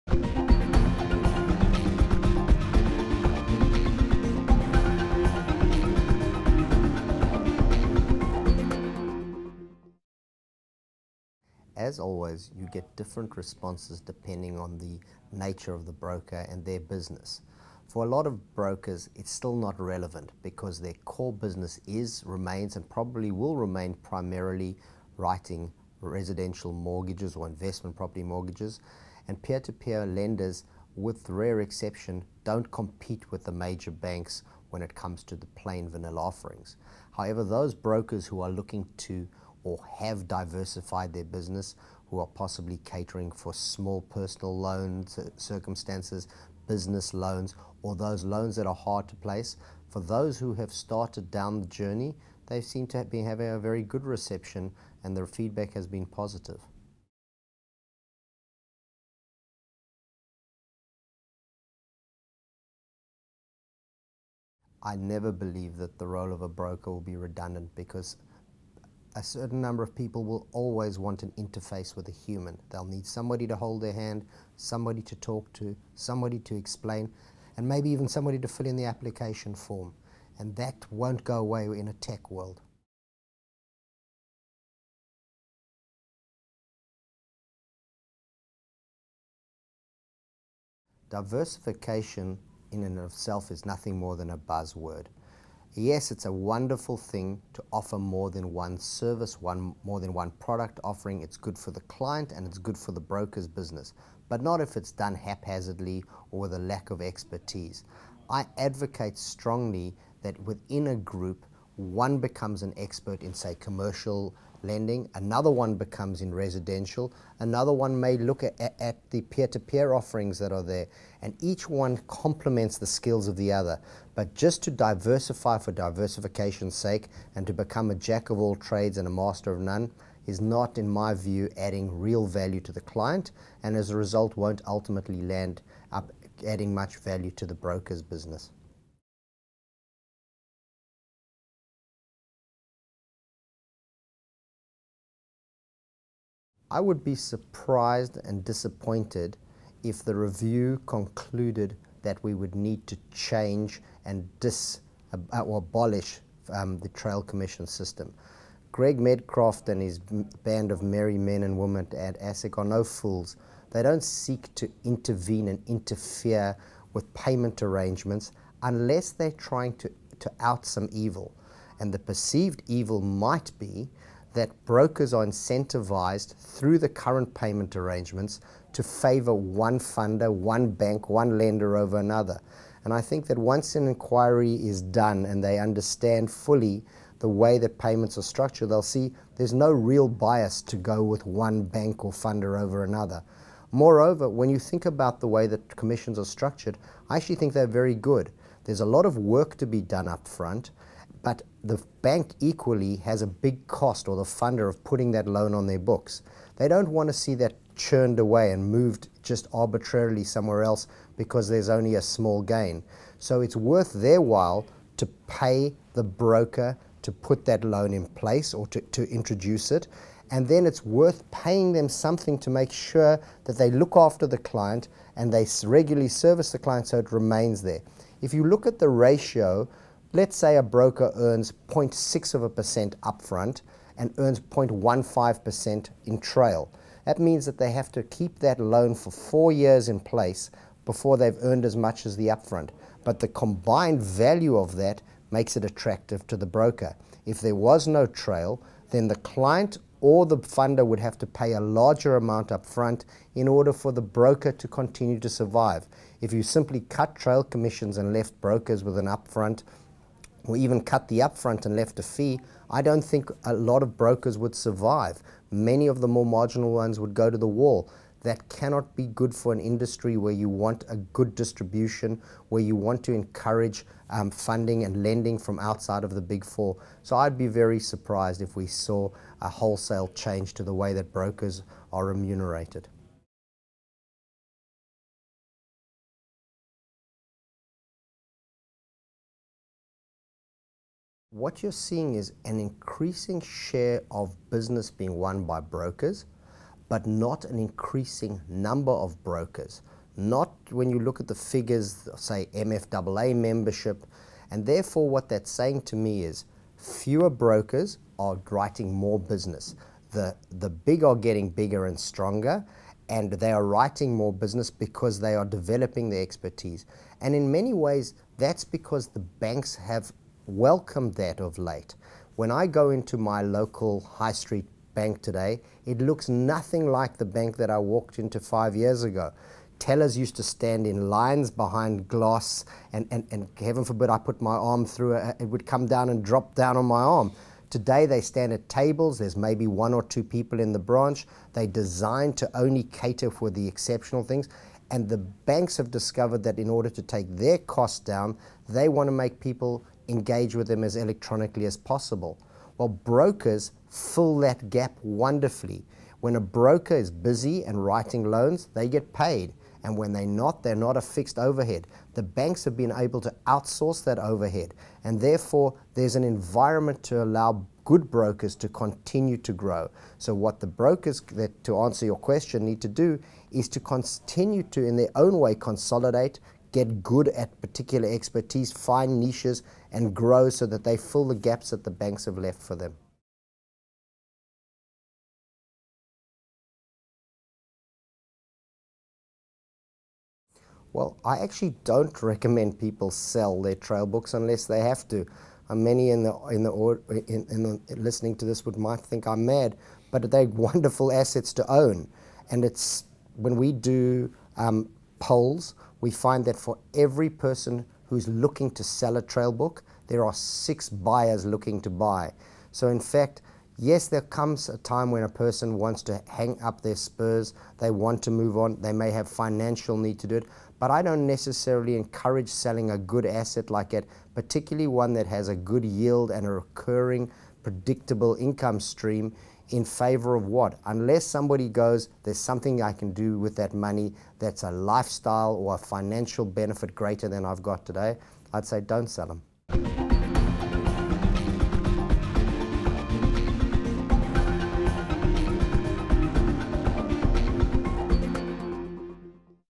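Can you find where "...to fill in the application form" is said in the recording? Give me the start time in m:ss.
1:18.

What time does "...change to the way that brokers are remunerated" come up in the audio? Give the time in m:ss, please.
4:40.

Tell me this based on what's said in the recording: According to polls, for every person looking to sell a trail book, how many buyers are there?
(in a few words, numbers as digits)
6.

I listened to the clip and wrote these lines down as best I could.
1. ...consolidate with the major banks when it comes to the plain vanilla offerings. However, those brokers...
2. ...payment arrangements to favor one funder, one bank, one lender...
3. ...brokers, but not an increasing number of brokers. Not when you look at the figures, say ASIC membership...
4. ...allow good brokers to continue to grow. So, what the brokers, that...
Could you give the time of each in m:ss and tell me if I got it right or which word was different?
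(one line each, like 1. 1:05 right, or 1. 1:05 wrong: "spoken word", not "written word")
1. 0:32 wrong: "compete", not "consolidate"
2. 2:57 right
3. 4:55 wrong: "MFAA", not "ASIC"
4. 6:07 right.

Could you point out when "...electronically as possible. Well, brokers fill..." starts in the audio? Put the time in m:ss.
5:50.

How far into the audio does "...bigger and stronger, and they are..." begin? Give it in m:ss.
5:11.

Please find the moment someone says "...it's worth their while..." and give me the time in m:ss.
3:33.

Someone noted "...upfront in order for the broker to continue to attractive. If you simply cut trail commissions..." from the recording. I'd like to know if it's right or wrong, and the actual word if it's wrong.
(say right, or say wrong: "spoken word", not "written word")
wrong: "survive", not "attractive".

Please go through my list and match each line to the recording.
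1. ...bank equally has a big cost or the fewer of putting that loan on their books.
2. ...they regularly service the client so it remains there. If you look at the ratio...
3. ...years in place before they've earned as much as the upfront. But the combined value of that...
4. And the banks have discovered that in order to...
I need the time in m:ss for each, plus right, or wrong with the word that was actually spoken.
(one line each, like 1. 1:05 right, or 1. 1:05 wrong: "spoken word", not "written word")
1. 3:22 wrong: "funder", not "fewer"
2. 3:45 right
3. 3:59 right
4. 5:44 right.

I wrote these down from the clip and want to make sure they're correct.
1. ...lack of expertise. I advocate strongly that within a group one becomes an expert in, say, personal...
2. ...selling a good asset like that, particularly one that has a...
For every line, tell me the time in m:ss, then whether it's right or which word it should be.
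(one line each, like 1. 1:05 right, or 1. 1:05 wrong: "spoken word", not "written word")
1. 1:46 wrong: "commercial", not "personal"
2. 7:02 right.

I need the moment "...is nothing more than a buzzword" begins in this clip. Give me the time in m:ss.
1:33.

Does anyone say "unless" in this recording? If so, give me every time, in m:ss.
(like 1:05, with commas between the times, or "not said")
2:48, 6:34, 7:10.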